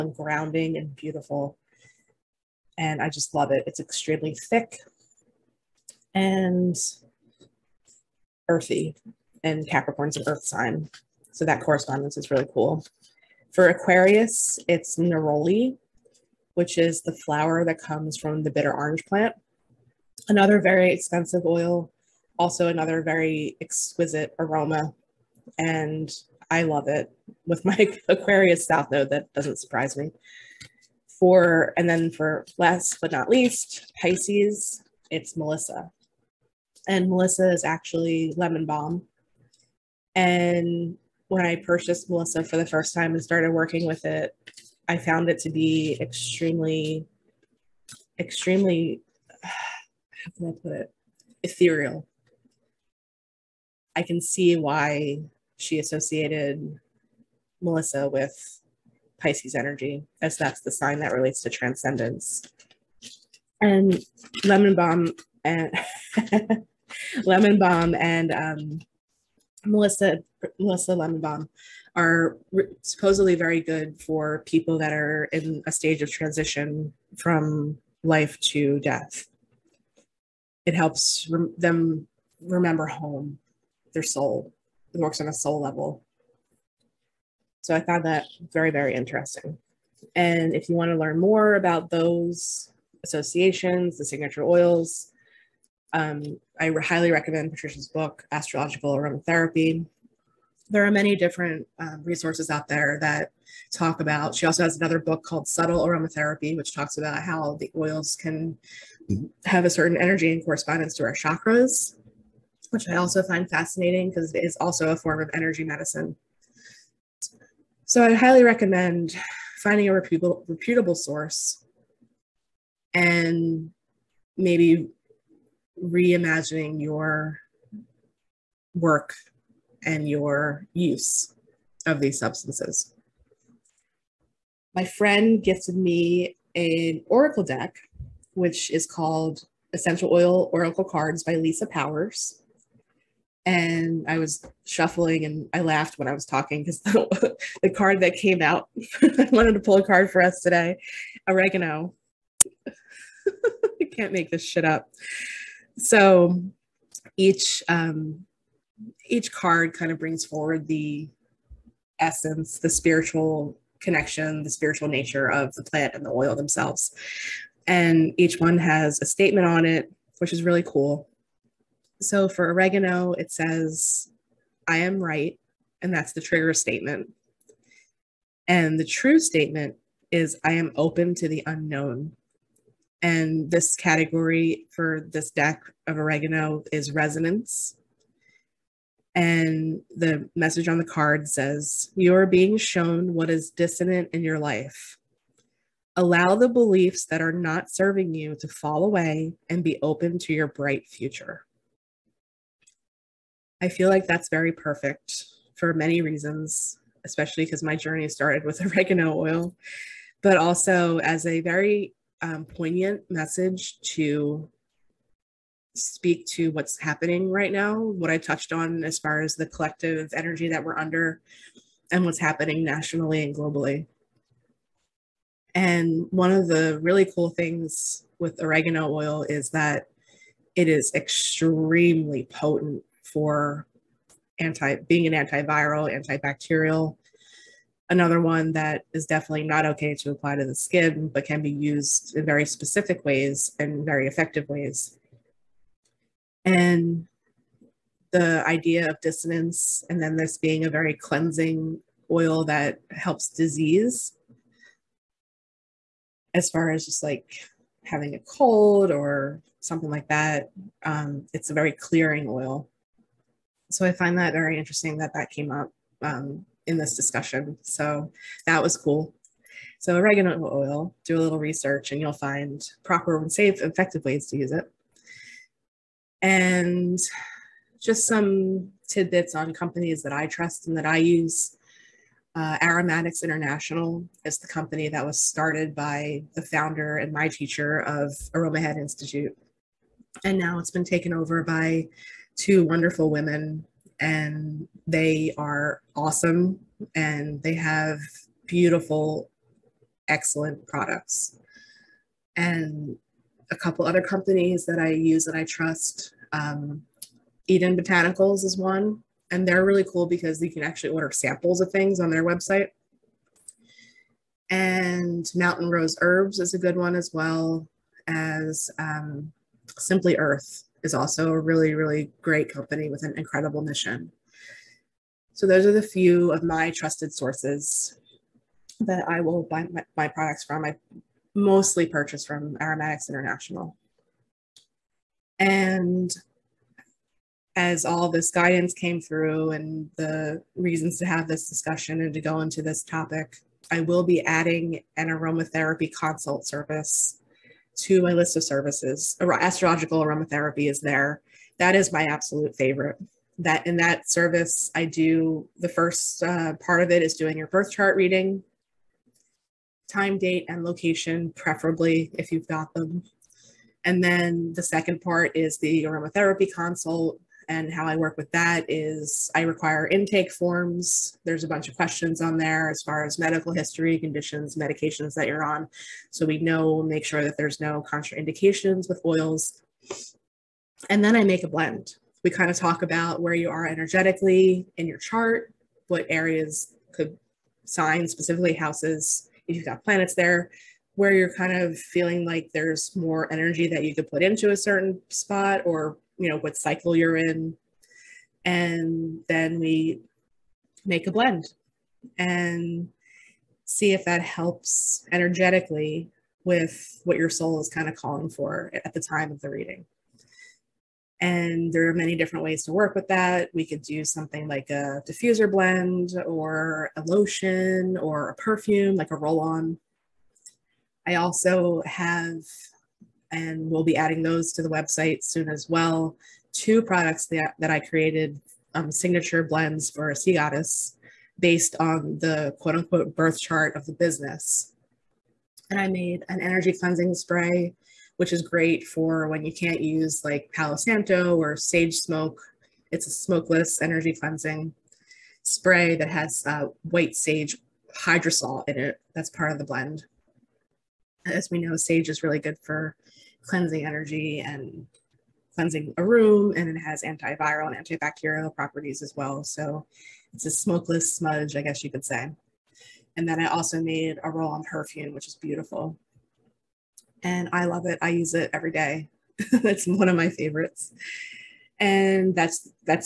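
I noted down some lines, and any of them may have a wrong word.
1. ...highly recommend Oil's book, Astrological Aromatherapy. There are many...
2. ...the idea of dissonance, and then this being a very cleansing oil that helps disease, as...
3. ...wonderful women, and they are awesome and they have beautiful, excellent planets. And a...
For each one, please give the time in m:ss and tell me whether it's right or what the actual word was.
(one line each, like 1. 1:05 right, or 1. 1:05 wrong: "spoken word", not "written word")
1. 1:36 wrong: "Patricia", not "Oil"
2. 4:08 right
3. 4:52 wrong: "products", not "planets".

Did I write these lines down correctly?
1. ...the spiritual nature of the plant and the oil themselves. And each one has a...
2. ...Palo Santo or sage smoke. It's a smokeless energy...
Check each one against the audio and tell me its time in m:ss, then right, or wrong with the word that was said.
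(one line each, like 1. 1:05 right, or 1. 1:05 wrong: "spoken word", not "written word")
1. 2:44 right
2. 7:20 right.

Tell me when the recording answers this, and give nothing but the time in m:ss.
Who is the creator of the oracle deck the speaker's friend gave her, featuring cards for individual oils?
2:21.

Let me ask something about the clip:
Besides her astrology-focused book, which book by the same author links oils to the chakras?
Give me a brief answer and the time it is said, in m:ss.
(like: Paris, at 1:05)
Subtle Aromatherapy, at 1:45.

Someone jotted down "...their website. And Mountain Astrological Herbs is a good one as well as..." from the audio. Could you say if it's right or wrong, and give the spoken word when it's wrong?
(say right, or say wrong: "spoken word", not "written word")
wrong: "Rose", not "Astrological".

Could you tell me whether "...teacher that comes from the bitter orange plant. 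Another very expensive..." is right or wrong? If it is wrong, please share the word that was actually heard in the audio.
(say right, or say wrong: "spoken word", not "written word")
wrong: "flower", not "teacher".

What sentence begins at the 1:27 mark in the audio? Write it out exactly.
So I found that very, very interesting.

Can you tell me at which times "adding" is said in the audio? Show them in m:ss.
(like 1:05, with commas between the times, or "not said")
5:44, 7:03.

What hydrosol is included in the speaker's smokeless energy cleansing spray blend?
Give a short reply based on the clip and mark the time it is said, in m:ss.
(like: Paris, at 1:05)
White sage, at 7:26.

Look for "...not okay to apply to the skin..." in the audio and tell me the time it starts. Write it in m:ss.
3:59.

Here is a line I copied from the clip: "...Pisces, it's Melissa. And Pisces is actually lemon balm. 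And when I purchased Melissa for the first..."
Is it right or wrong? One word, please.
wrong.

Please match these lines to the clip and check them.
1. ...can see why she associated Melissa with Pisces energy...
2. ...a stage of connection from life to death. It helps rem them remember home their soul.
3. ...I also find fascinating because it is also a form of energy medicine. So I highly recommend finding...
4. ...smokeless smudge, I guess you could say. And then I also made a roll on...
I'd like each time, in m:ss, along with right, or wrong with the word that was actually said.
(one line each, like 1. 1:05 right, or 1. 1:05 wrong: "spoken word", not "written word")
1. 0:54 right
2. 1:15 wrong: "transition", not "connection"
3. 1:52 right
4. 7:40 right.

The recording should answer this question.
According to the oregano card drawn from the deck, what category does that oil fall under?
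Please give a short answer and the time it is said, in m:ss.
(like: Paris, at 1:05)
Resonance, at 3:06.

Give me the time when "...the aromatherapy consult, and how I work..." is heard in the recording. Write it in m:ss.
6:05.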